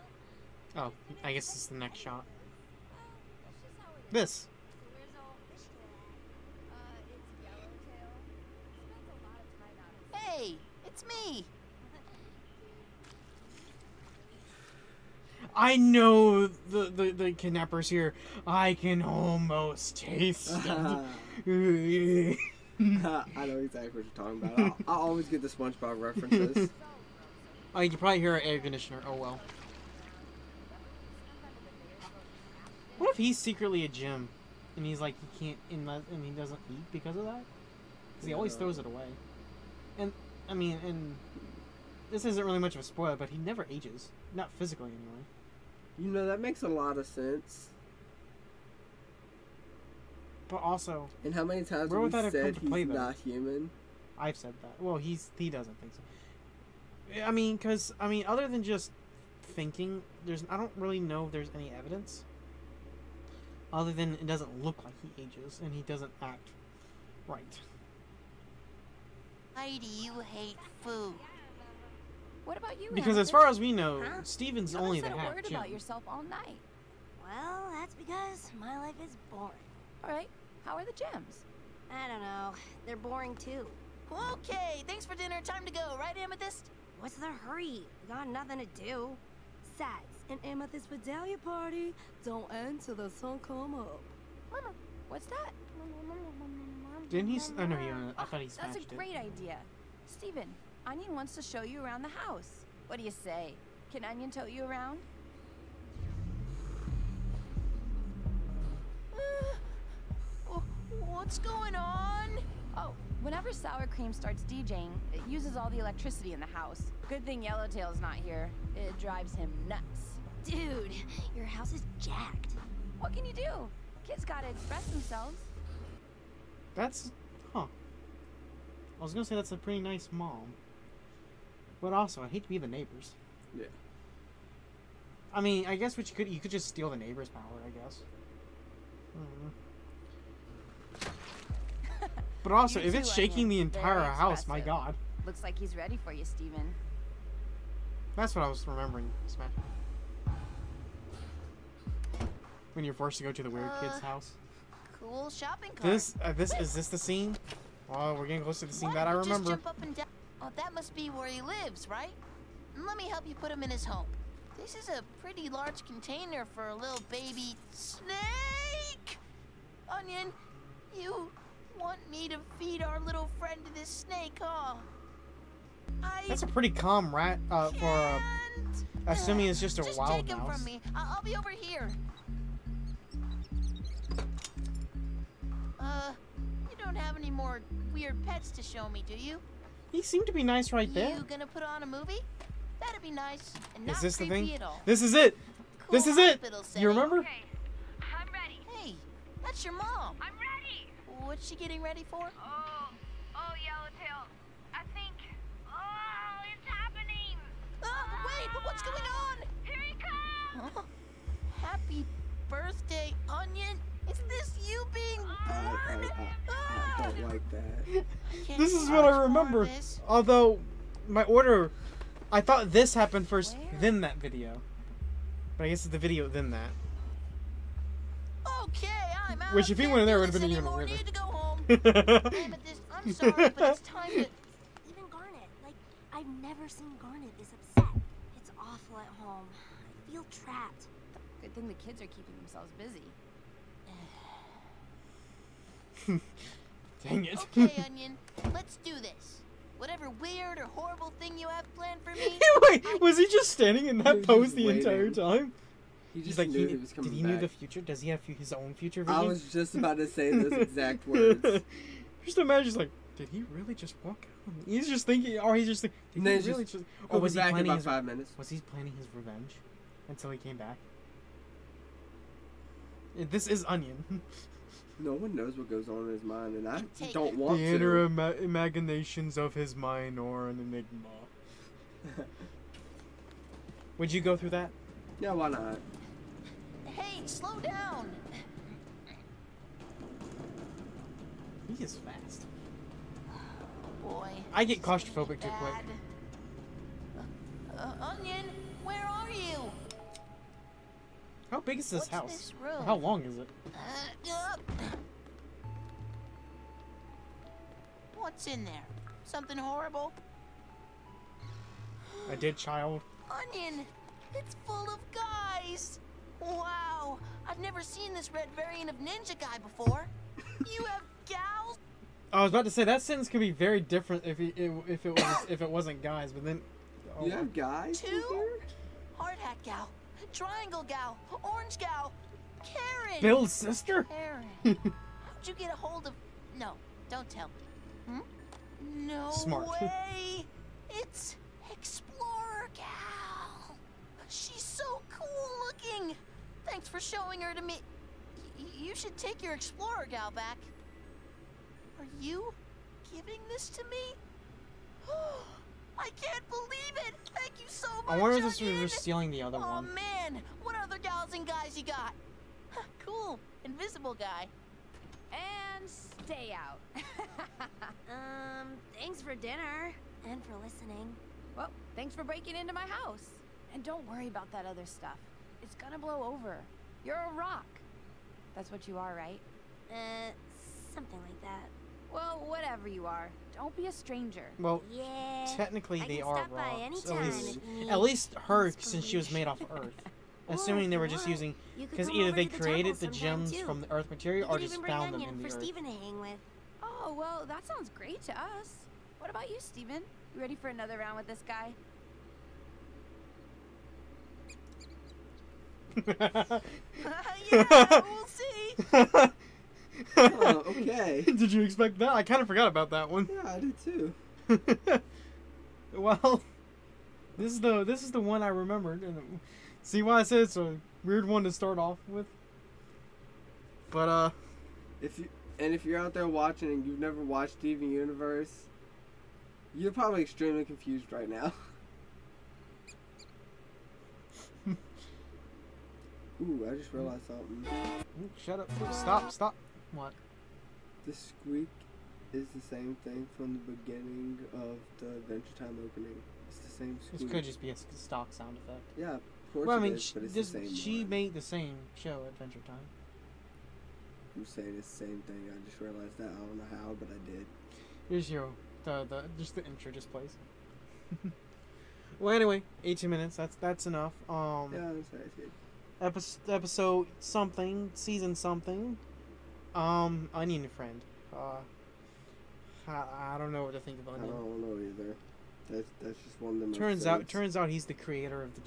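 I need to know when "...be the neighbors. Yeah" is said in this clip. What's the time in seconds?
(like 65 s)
132 s.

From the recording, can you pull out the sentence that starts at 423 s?
But uh, if you and if you're out there watching and you've never watched Steven Universe, you're probably extremely confused right now.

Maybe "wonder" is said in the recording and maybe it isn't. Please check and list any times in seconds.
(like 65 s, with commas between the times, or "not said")
358 s.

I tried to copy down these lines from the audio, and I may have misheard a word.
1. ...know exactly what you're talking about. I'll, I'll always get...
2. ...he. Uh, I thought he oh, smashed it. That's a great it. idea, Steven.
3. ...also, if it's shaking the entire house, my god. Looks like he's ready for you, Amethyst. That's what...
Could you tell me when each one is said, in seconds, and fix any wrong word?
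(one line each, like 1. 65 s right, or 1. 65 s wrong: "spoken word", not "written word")
1. 21 s right
2. 97 s right
3. 142 s wrong: "Steven", not "Amethyst".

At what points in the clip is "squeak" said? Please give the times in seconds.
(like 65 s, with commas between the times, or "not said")
441 s, 447 s.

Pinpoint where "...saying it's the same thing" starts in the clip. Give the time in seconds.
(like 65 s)
454 s.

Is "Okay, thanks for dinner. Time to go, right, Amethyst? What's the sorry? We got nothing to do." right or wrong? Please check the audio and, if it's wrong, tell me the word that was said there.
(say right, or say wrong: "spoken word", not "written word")
wrong: "hurry", not "sorry".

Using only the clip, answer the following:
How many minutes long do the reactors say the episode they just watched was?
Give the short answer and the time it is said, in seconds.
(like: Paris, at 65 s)
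18, at 462 s.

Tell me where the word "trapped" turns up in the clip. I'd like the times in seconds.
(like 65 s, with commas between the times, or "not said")
240 s.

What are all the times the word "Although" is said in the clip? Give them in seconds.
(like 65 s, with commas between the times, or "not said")
220 s.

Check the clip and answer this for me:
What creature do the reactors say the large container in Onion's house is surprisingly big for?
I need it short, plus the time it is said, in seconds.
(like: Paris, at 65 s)
a little baby snake, at 166 s.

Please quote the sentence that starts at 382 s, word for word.
Well, whatever you are, don't be a stranger.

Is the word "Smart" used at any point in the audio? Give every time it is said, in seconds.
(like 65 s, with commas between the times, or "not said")
339 s.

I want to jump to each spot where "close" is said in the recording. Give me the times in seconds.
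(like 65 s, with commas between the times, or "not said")
158 s.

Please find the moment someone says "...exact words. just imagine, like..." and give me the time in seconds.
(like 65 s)
260 s.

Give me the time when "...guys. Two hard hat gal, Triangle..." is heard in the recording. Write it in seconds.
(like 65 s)
327 s.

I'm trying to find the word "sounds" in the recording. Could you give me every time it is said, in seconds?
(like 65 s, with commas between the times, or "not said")
397 s, 448 s.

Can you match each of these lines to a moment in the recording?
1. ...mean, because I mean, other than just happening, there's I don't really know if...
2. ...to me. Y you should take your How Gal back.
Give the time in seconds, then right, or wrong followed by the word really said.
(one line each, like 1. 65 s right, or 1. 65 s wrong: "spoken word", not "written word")
1. 57 s wrong: "thinking", not "happening"
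2. 347 s wrong: "Explorer", not "How".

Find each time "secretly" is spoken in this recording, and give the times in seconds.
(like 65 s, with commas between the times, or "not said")
33 s.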